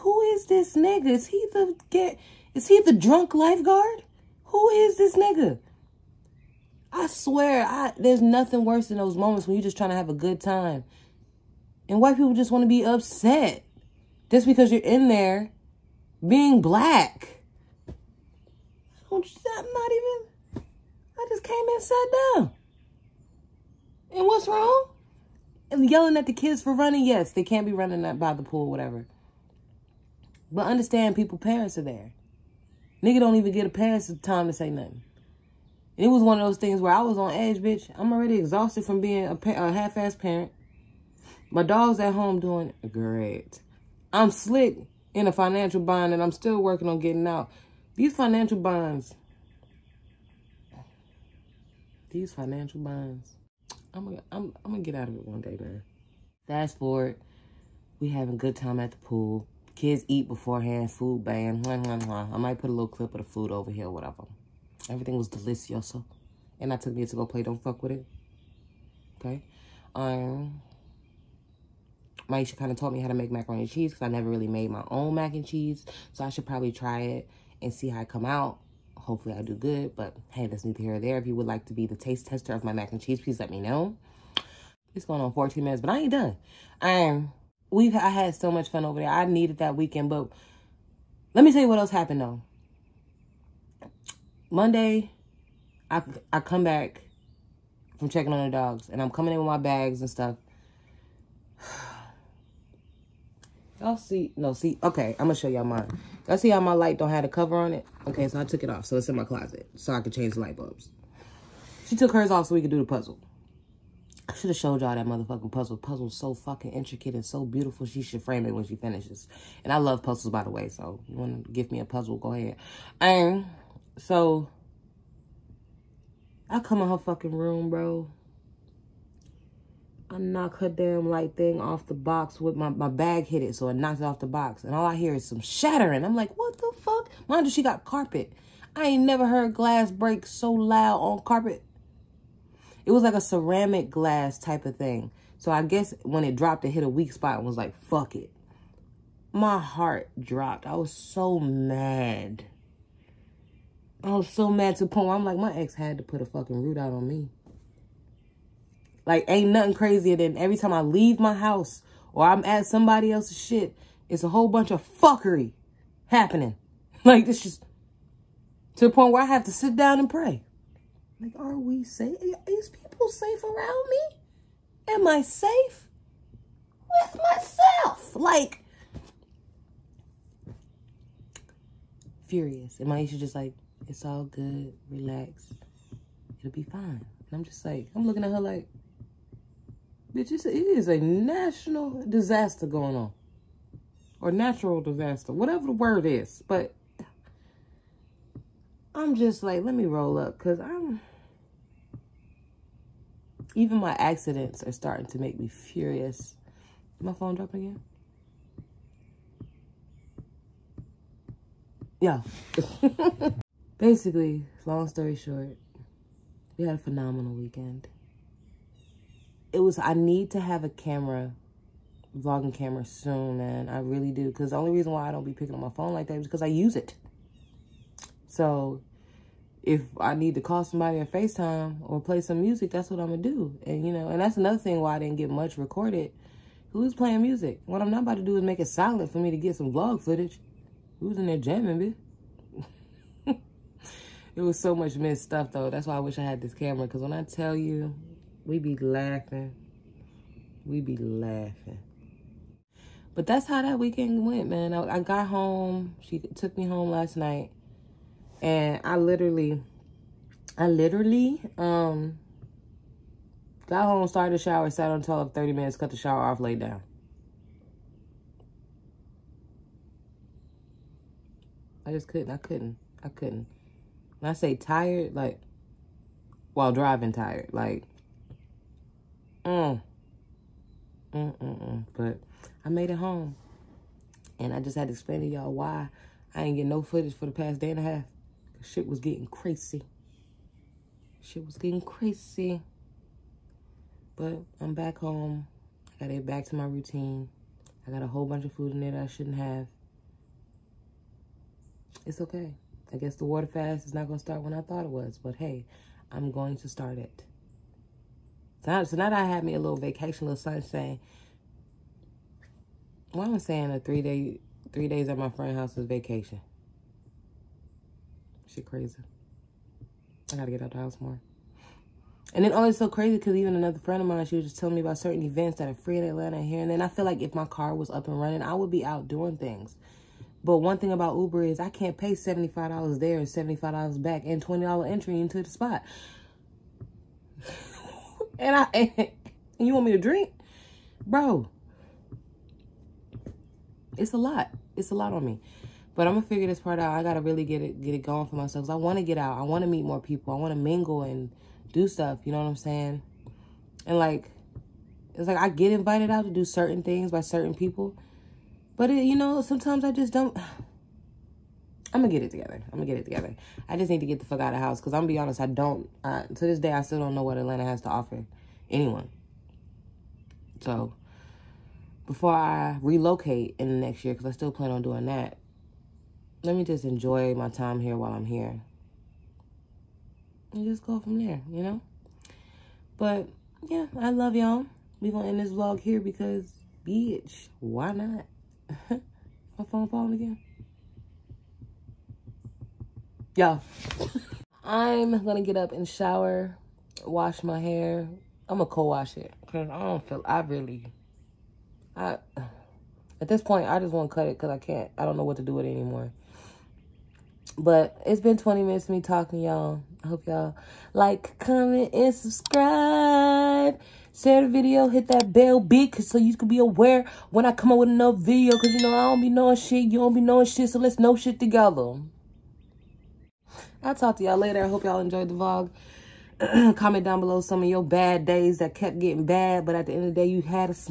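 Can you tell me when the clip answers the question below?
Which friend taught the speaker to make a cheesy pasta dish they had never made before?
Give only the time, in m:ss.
1:12.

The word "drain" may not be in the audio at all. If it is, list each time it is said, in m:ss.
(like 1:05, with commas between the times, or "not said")
not said.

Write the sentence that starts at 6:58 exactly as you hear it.
Because, you know, I don't be knowing shit.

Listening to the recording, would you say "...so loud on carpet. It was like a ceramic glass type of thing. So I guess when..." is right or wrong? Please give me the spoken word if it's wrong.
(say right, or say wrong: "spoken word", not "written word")
right.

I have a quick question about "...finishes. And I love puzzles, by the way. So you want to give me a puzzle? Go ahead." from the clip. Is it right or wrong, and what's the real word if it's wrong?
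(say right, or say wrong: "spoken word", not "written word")
right.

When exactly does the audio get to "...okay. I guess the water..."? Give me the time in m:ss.
5:02.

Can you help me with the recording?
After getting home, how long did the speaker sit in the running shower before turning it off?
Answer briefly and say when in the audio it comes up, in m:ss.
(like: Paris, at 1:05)
30 minutes, at 4:25.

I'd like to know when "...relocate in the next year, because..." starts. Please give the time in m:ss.
6:12.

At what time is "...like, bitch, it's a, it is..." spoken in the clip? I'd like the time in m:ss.
3:08.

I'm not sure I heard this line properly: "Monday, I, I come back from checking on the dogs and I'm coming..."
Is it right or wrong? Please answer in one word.
right.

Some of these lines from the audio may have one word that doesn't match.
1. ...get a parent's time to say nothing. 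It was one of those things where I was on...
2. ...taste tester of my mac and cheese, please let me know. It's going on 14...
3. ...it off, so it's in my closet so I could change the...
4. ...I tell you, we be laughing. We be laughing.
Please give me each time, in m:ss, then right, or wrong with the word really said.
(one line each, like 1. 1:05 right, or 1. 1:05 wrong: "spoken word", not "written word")
1. 0:33 right
2. 1:21 right
3. 1:48 right
4. 4:07 right.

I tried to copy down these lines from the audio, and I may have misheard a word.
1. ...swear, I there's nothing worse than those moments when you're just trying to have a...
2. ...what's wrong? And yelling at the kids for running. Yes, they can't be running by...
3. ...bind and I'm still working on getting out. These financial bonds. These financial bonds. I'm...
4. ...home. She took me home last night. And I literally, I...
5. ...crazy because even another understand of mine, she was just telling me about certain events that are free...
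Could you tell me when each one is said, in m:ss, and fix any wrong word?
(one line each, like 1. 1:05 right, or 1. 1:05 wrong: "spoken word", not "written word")
1. 0:07 right
2. 0:24 right
3. 0:45 right
4. 4:15 right
5. 5:22 wrong: "friend", not "understand".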